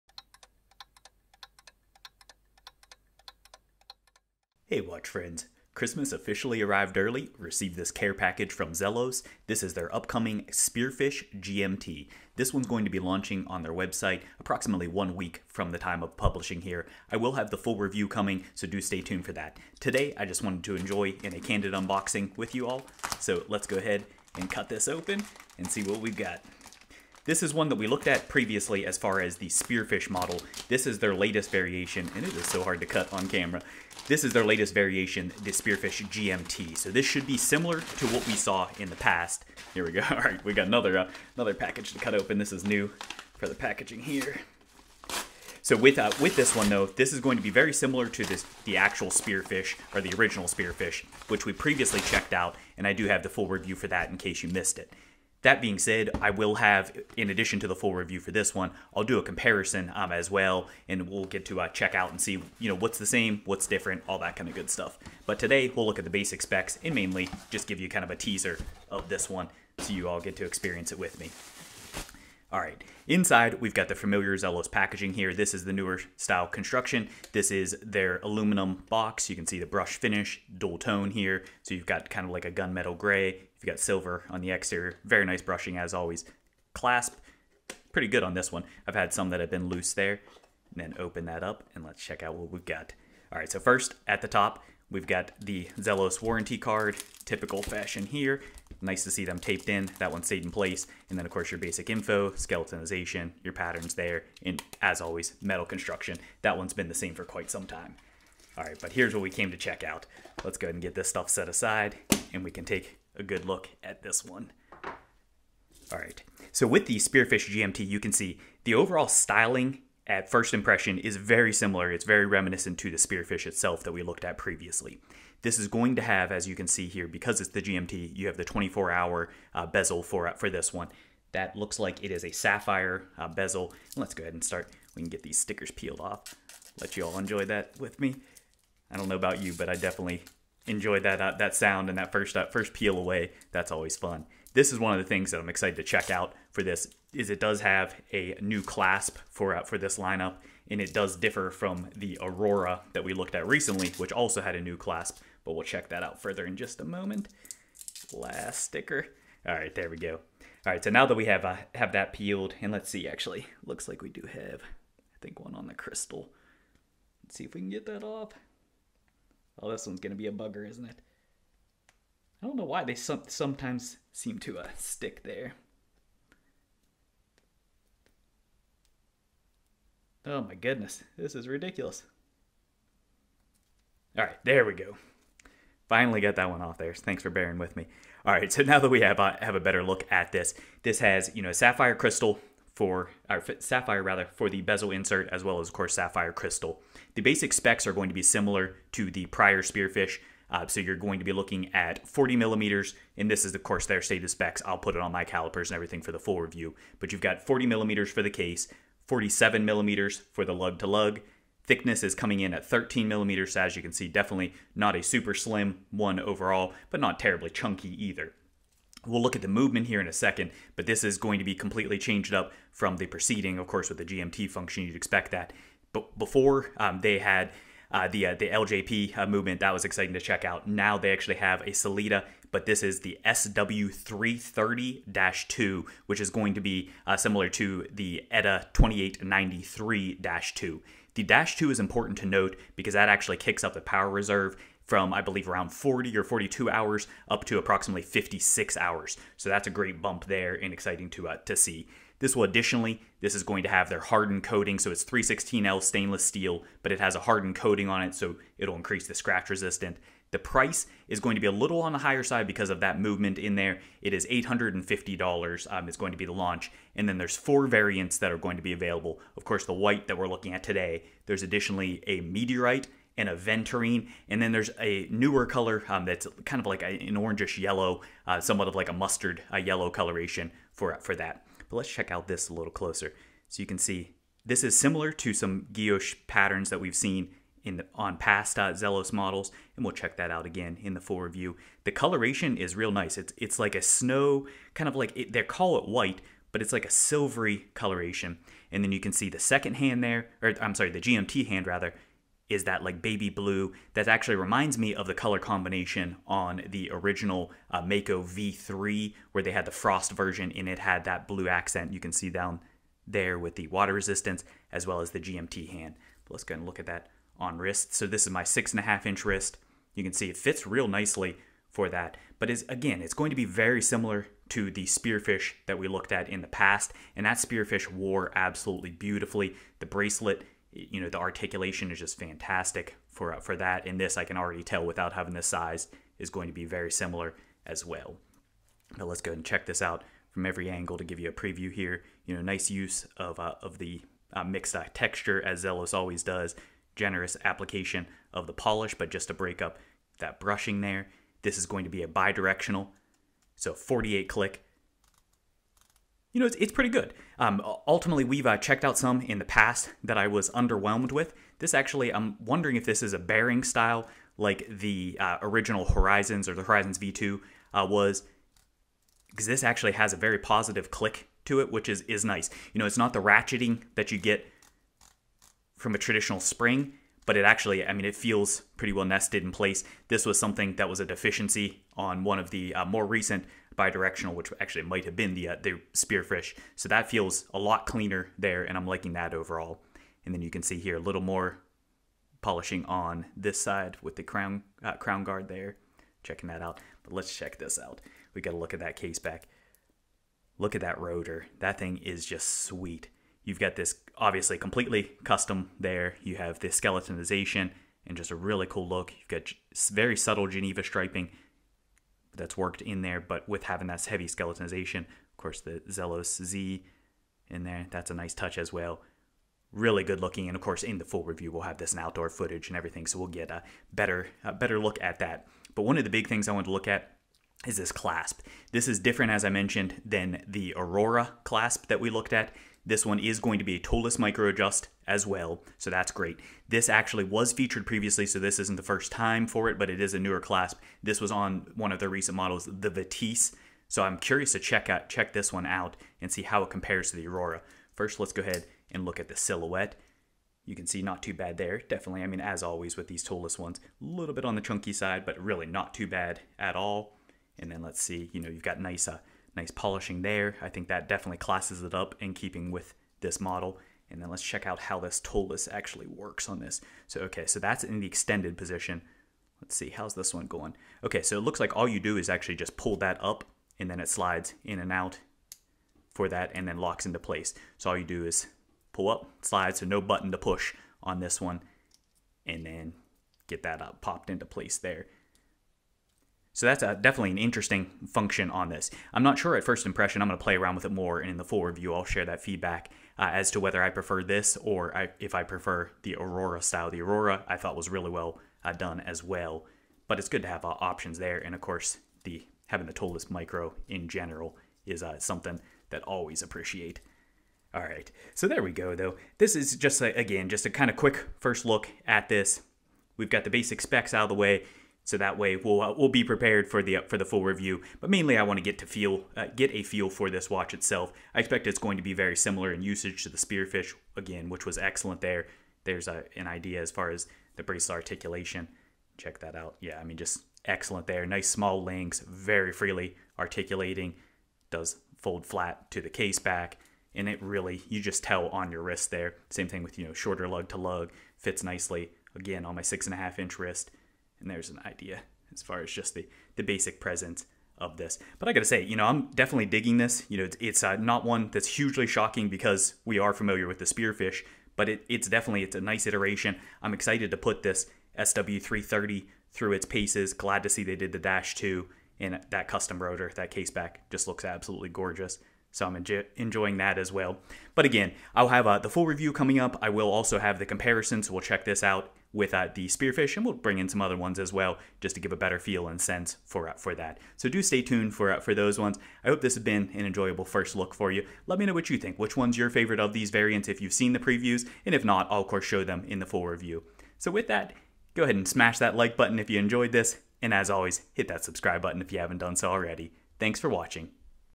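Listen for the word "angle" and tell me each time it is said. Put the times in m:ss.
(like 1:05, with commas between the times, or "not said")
5:40.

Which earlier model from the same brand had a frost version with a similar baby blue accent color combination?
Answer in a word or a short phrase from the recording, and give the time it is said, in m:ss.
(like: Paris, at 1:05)
Mako V3, at 5:07.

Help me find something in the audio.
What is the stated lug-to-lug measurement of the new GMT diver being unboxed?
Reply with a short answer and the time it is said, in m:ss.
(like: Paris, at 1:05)
47 millimeters, at 3:29.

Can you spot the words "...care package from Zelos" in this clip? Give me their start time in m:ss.
0:07.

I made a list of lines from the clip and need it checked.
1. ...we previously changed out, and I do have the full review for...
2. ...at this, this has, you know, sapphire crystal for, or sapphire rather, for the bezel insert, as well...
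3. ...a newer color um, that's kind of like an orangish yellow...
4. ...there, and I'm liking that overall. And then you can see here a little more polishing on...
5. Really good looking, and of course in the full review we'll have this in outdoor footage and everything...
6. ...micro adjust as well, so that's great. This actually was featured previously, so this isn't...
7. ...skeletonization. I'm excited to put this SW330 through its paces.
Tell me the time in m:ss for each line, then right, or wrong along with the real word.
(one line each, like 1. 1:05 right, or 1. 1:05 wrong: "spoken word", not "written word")
1. 0:51 wrong: "checked", not "changed"
2. 3:10 right
3. 4:34 right
4. 6:28 right
5. 6:59 right
6. 7:14 right
7. 9:16 wrong: "iteration", not "skeletonization".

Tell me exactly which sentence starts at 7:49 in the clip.
Let's see, how's this one going?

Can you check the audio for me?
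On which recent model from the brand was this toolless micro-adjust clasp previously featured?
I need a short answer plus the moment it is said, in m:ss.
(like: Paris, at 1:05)
Vitesse, at 7:22.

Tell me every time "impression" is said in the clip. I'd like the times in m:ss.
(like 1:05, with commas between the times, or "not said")
2:00, 8:09.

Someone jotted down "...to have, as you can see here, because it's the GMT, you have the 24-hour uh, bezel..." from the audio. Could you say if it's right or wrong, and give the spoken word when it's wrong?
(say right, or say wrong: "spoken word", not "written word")
right.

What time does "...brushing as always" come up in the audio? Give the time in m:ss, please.
1:25.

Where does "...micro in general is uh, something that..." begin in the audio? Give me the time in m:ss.
8:23.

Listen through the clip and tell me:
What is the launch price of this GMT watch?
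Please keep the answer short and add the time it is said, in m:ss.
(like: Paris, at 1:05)
$850, at 4:24.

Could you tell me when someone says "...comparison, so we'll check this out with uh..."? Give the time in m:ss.
9:30.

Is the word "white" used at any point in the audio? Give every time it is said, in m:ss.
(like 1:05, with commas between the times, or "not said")
4:29, 4:55.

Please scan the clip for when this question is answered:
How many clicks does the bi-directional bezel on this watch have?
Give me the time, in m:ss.
5:53.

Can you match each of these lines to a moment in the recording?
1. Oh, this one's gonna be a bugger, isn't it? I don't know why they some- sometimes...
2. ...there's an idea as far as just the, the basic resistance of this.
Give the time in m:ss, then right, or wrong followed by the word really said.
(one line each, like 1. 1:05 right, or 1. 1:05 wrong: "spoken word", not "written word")
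1. 2:49 right
2. 9:04 wrong: "presence", not "resistance".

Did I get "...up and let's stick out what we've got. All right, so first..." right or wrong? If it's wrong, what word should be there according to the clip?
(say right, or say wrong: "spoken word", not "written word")
wrong: "check", not "stick".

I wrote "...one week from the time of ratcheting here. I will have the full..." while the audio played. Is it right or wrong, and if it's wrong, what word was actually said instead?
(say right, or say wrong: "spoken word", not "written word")
wrong: "publishing", not "ratcheting".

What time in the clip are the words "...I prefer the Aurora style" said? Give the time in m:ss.
8:15.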